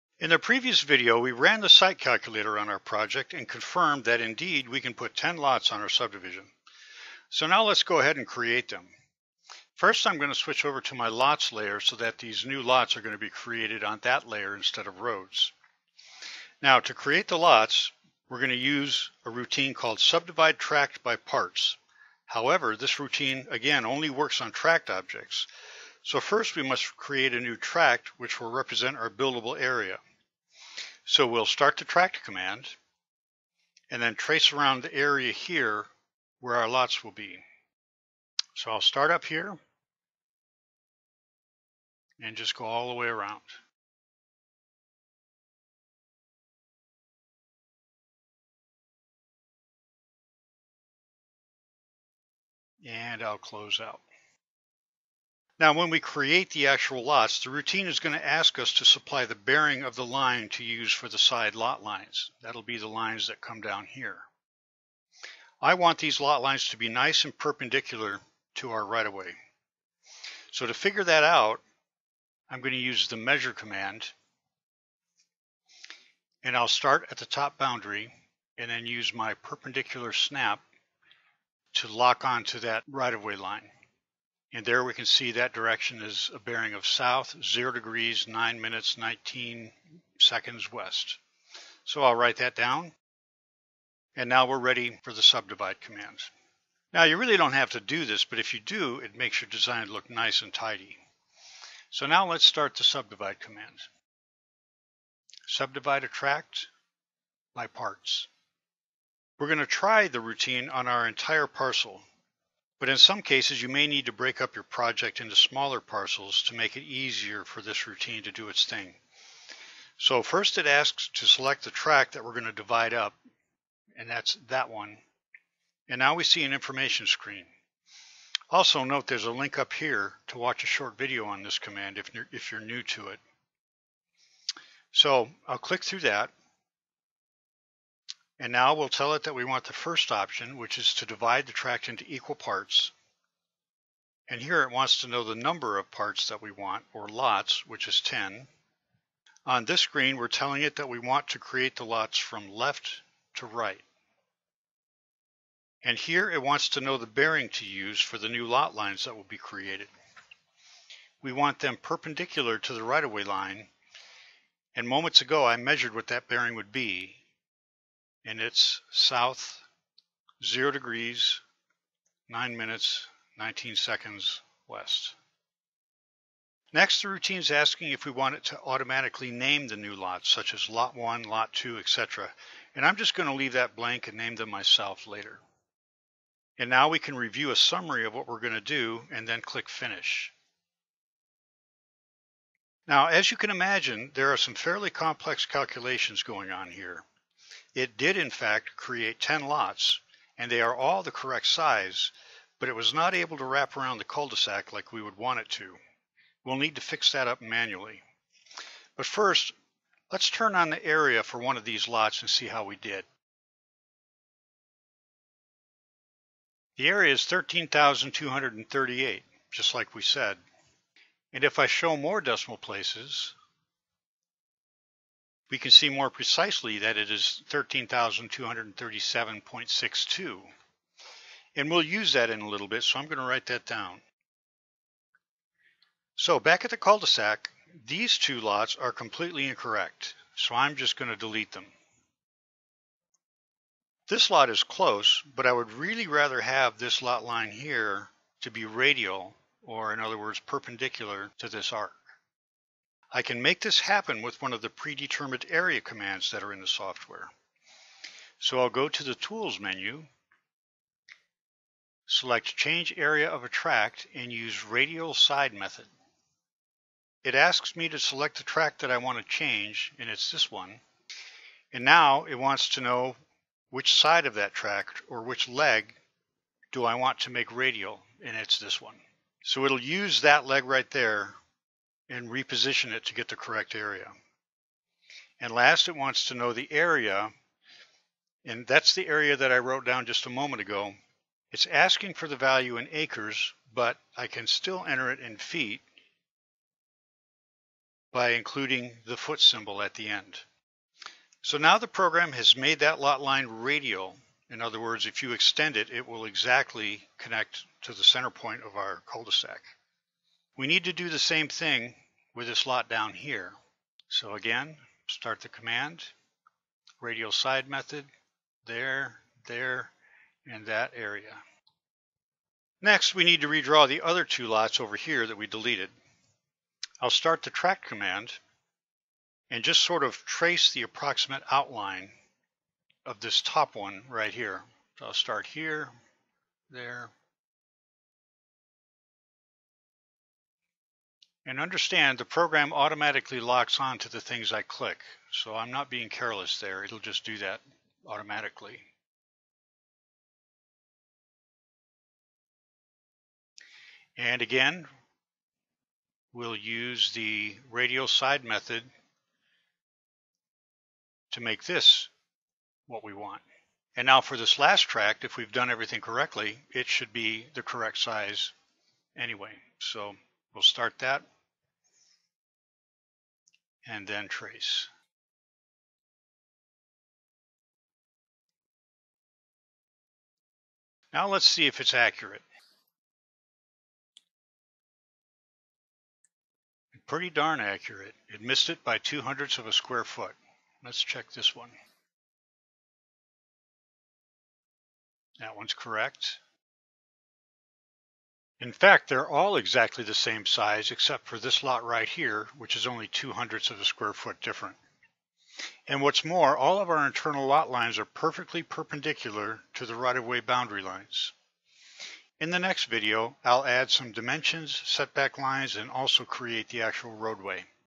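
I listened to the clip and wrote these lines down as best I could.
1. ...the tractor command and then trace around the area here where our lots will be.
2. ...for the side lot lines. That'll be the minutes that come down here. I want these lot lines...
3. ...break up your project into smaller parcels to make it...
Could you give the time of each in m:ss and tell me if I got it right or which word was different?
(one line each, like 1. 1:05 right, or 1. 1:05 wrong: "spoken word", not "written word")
1. 0:31 right
2. 1:00 wrong: "lines", not "minutes"
3. 1:54 right.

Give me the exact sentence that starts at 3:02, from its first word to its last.
And I'm just going to leave that blank and name them myself later.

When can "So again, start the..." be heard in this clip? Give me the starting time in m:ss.
5:14.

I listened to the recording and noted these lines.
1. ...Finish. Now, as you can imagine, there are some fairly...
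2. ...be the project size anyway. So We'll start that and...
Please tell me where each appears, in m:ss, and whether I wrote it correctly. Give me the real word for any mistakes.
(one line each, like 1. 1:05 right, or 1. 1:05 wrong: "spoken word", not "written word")
1. 3:09 right
2. 6:07 wrong: "correct", not "project".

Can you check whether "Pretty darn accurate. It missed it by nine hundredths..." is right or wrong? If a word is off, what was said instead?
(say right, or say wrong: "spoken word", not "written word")
wrong: "two", not "nine".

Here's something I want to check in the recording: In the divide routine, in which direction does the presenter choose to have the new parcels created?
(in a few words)
left to right.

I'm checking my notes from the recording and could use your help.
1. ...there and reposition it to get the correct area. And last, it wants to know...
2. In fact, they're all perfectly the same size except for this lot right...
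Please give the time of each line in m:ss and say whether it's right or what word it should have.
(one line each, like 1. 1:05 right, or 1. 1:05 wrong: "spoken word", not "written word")
1. 4:40 right
2. 6:38 wrong: "exactly", not "perfectly".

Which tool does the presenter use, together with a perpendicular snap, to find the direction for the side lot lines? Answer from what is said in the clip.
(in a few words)
measure command.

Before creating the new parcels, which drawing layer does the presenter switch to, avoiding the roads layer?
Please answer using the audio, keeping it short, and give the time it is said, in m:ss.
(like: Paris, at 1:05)
lots layer, at 0:11.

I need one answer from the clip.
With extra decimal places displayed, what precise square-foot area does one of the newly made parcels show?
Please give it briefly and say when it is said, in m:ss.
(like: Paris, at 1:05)
13,237.62, at 3:47.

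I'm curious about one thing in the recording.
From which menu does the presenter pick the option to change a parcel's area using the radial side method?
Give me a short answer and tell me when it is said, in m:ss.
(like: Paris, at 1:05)
Tools menu, at 4:19.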